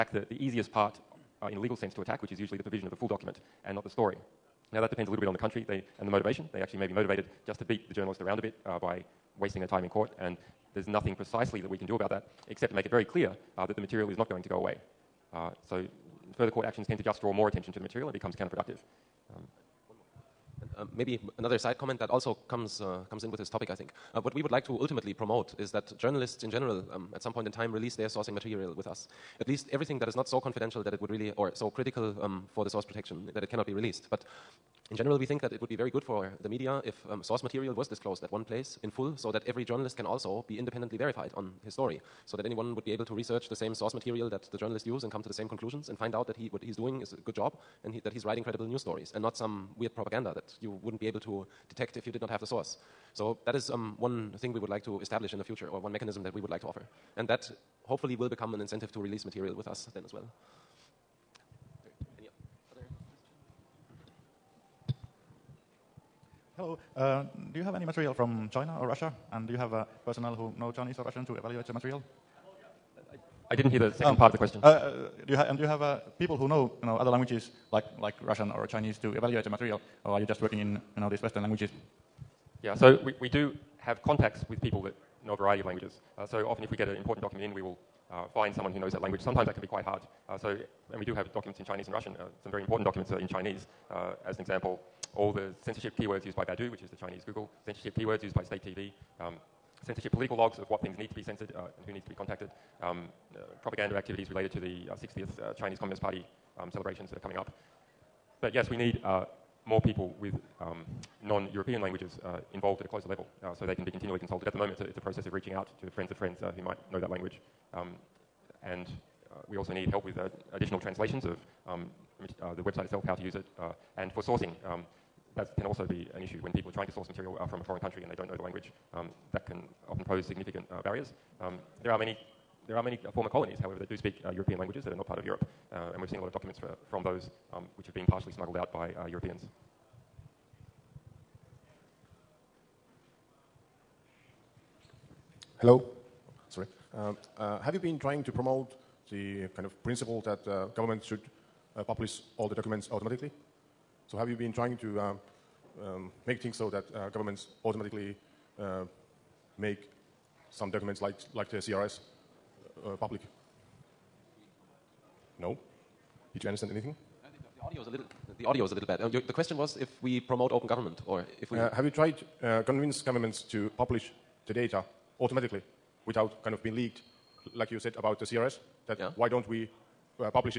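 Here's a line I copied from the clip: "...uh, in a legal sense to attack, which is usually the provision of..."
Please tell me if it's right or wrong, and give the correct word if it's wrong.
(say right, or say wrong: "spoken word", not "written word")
right.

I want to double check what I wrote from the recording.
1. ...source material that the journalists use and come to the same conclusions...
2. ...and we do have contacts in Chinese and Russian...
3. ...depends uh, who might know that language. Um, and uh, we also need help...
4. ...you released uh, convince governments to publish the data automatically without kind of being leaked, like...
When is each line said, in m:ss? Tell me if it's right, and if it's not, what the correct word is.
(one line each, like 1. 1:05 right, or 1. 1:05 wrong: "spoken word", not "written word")
1. 0:43 right
2. 1:30 wrong: "documents", not "contacts"
3. 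1:56 wrong: "friends", not "depends"
4. 2:51 wrong: "tried", not "released".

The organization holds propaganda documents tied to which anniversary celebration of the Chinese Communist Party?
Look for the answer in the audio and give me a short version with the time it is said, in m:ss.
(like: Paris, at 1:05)
60th, at 1:45.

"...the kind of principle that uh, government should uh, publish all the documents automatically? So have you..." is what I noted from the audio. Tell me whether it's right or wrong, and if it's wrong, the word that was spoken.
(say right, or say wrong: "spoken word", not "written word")
right.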